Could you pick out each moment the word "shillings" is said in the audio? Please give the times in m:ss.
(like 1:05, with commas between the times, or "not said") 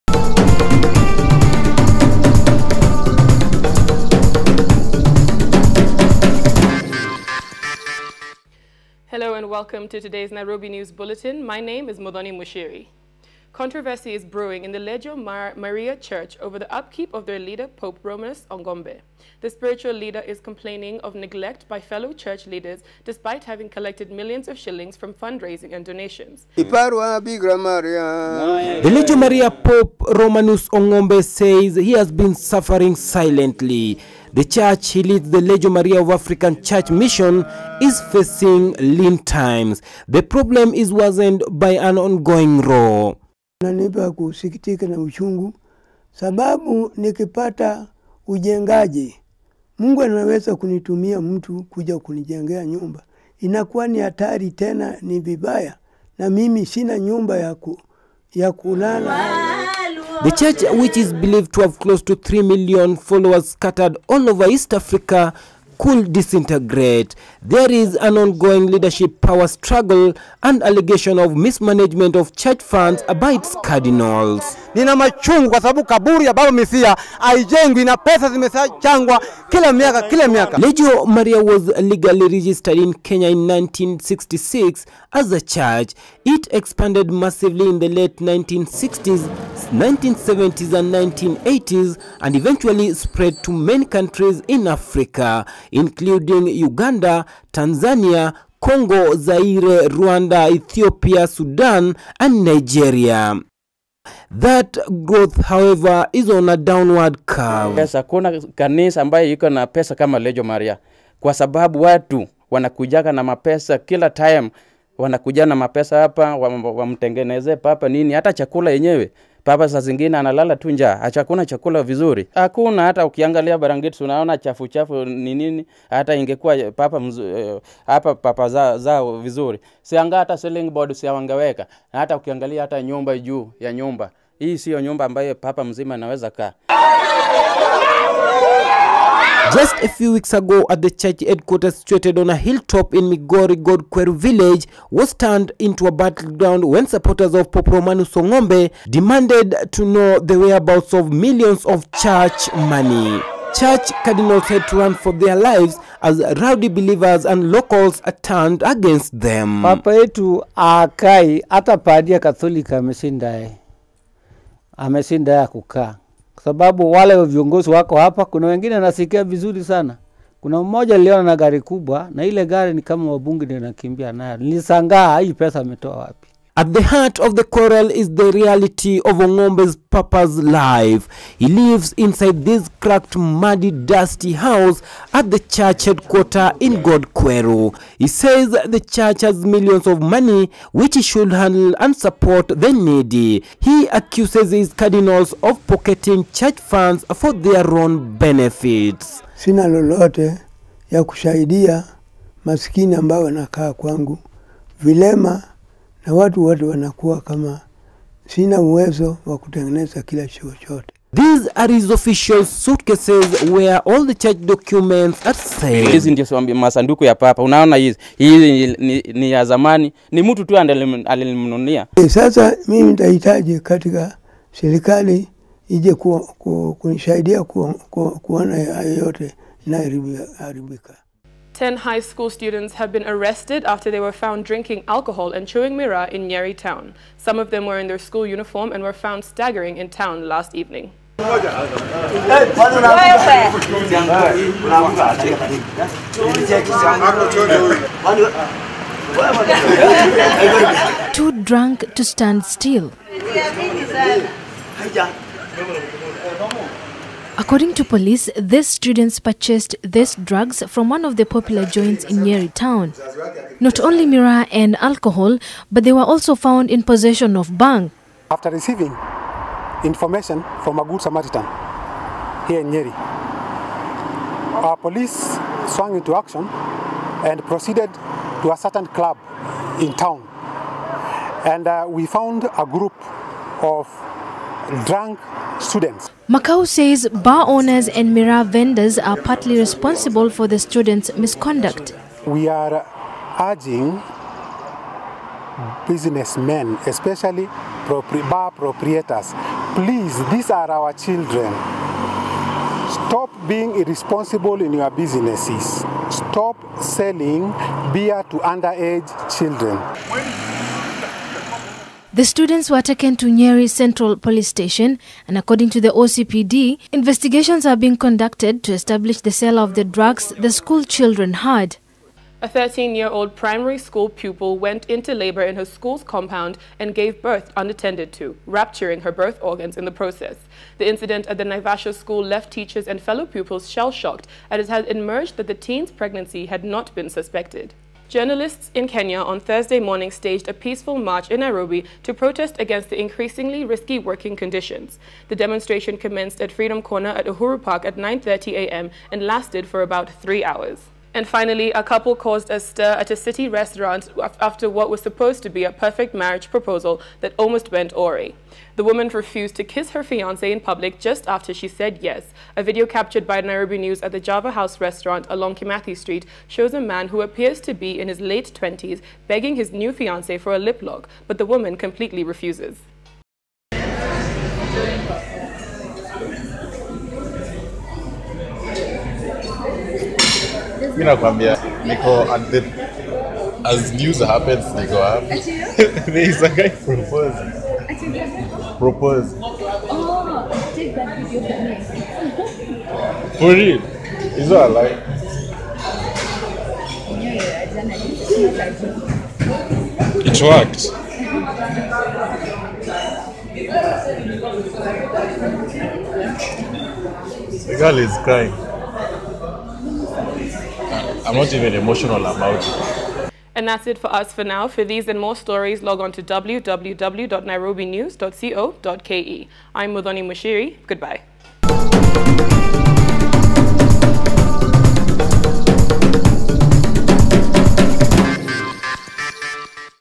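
0:24.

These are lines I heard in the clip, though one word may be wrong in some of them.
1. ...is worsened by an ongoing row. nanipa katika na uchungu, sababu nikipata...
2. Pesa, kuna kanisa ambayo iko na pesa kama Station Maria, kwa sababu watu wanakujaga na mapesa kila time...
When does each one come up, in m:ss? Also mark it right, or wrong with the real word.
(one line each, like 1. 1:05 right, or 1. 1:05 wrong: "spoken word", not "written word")
1. 0:40 wrong: "kusikitika", not "katika"
2. 1:47 wrong: "Lejo", not "Station".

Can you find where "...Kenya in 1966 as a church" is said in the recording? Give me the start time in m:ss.
1:22.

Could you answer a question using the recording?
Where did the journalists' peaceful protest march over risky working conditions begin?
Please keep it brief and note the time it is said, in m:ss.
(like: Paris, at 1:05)
Freedom Corner, at 5:46.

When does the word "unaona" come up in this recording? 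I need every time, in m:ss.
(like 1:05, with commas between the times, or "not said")
2:04, 3:37.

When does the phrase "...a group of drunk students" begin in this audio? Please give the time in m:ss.
4:42.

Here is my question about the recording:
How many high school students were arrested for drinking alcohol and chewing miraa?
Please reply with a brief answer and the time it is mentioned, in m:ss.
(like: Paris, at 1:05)
10, at 3:51.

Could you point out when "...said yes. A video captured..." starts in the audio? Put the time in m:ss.
6:01.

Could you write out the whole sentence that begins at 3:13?
He accuses his cardinals of pocketing church funds for their own benefits.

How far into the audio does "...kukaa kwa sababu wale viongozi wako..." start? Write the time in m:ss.
2:45.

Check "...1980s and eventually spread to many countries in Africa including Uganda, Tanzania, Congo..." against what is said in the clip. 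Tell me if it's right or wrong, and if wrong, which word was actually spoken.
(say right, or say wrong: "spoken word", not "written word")
right.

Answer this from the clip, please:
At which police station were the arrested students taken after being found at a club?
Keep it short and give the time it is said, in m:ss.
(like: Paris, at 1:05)
Nyeri Central Police Station, at 5:13.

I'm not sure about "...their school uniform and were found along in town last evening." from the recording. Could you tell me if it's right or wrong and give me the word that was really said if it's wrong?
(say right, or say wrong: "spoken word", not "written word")
wrong: "staggering", not "along".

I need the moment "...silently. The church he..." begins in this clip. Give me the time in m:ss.
0:32.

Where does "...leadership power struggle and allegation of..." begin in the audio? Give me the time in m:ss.
1:08.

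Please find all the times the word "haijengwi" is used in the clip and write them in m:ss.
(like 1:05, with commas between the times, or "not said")
1:17.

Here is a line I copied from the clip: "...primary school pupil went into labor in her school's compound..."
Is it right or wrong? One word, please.
right.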